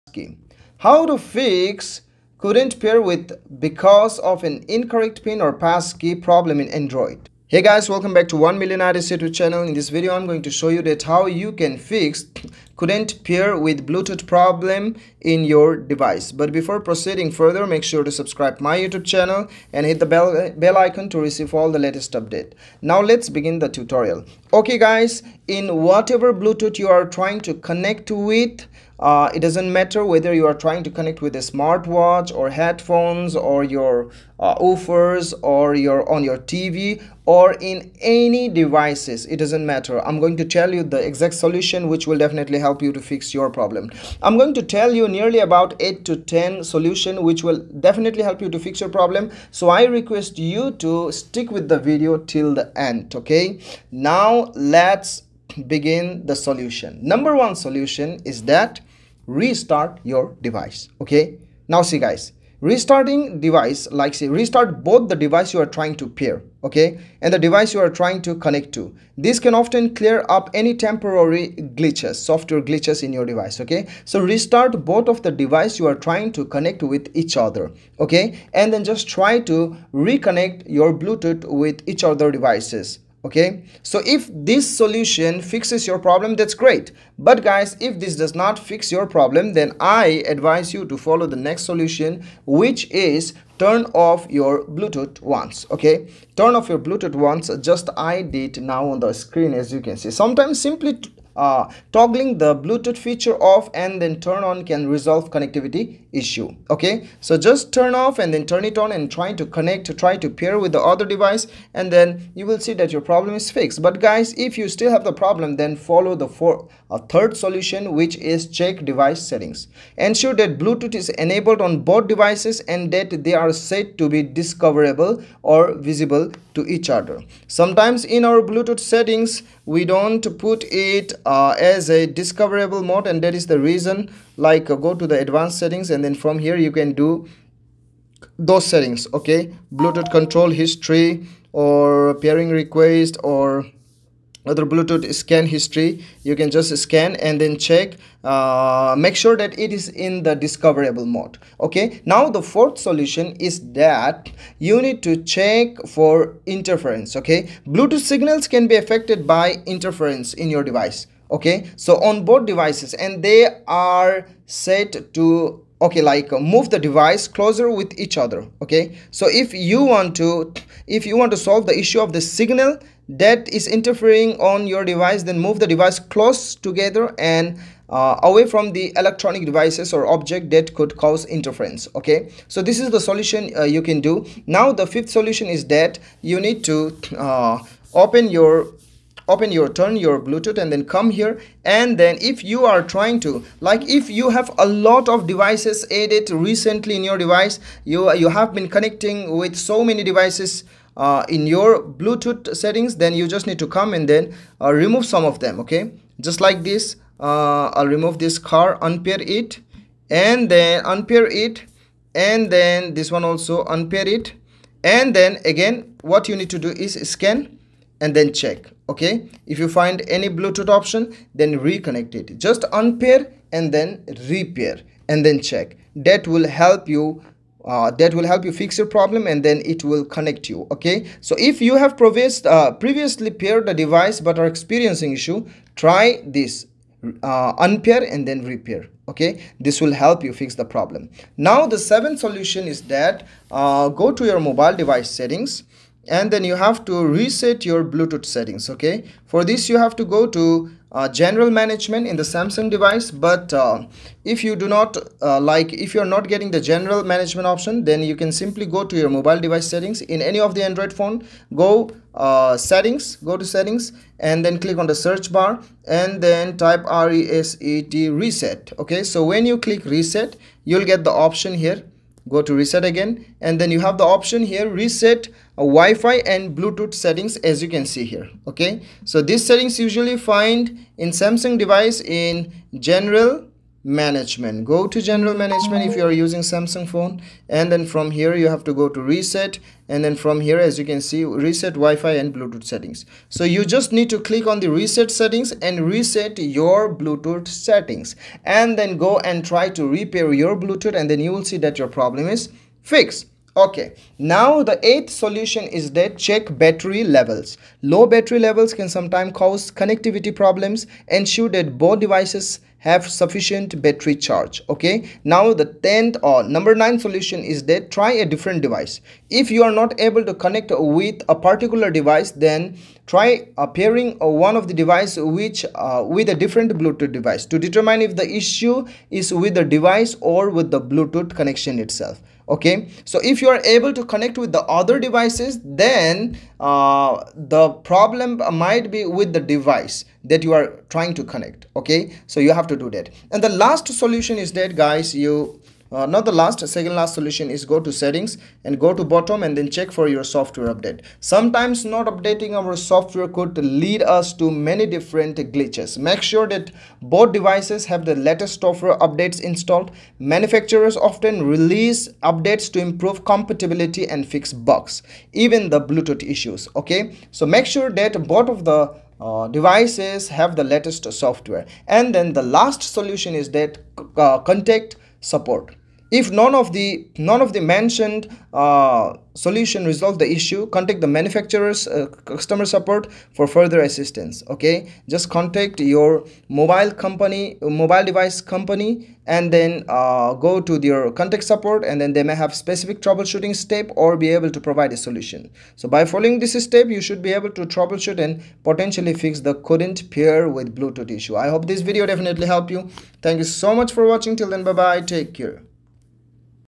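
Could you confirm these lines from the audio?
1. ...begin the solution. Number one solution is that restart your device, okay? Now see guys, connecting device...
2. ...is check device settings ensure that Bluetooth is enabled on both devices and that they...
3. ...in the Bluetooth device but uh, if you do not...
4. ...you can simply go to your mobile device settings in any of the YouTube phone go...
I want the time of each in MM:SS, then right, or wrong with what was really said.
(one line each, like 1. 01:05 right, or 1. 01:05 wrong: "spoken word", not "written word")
1. 00:55 wrong: "restarting", not "connecting"
2. 01:58 right
3. 04:12 wrong: "Samsung", not "Bluetooth"
4. 04:18 wrong: "Android", not "YouTube".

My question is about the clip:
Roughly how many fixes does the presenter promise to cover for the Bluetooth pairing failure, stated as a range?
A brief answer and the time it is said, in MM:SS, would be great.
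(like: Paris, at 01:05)
8 to 10, at 00:45.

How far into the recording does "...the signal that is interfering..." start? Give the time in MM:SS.
02:52.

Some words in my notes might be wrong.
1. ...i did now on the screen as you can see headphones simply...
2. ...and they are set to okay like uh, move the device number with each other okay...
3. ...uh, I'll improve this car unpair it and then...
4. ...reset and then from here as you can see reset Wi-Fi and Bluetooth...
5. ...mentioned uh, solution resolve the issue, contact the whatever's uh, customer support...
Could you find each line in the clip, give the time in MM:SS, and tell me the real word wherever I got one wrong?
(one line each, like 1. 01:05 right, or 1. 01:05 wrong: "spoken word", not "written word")
1. 01:37 wrong: "sometimes", not "headphones"
2. 02:42 wrong: "closer", not "number"
3. 03:27 wrong: "remove", not "improve"
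4. 04:49 right
5. 06:17 wrong: "manufacturer", not "whatever".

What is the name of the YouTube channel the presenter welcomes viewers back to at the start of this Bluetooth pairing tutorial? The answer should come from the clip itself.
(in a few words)
1 Million Ideas.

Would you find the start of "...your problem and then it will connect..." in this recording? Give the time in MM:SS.
03:48.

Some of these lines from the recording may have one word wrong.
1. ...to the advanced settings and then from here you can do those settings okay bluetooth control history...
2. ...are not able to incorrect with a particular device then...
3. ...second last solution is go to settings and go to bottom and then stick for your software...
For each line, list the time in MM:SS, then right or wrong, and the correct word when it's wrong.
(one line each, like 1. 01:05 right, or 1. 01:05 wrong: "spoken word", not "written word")
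1. 02:14 right
2. 05:19 wrong: "connect", not "incorrect"
3. 05:46 wrong: "check", not "stick".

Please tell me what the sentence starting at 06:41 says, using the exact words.
I hope this video definitely helped you.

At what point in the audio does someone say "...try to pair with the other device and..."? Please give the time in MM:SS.
01:49.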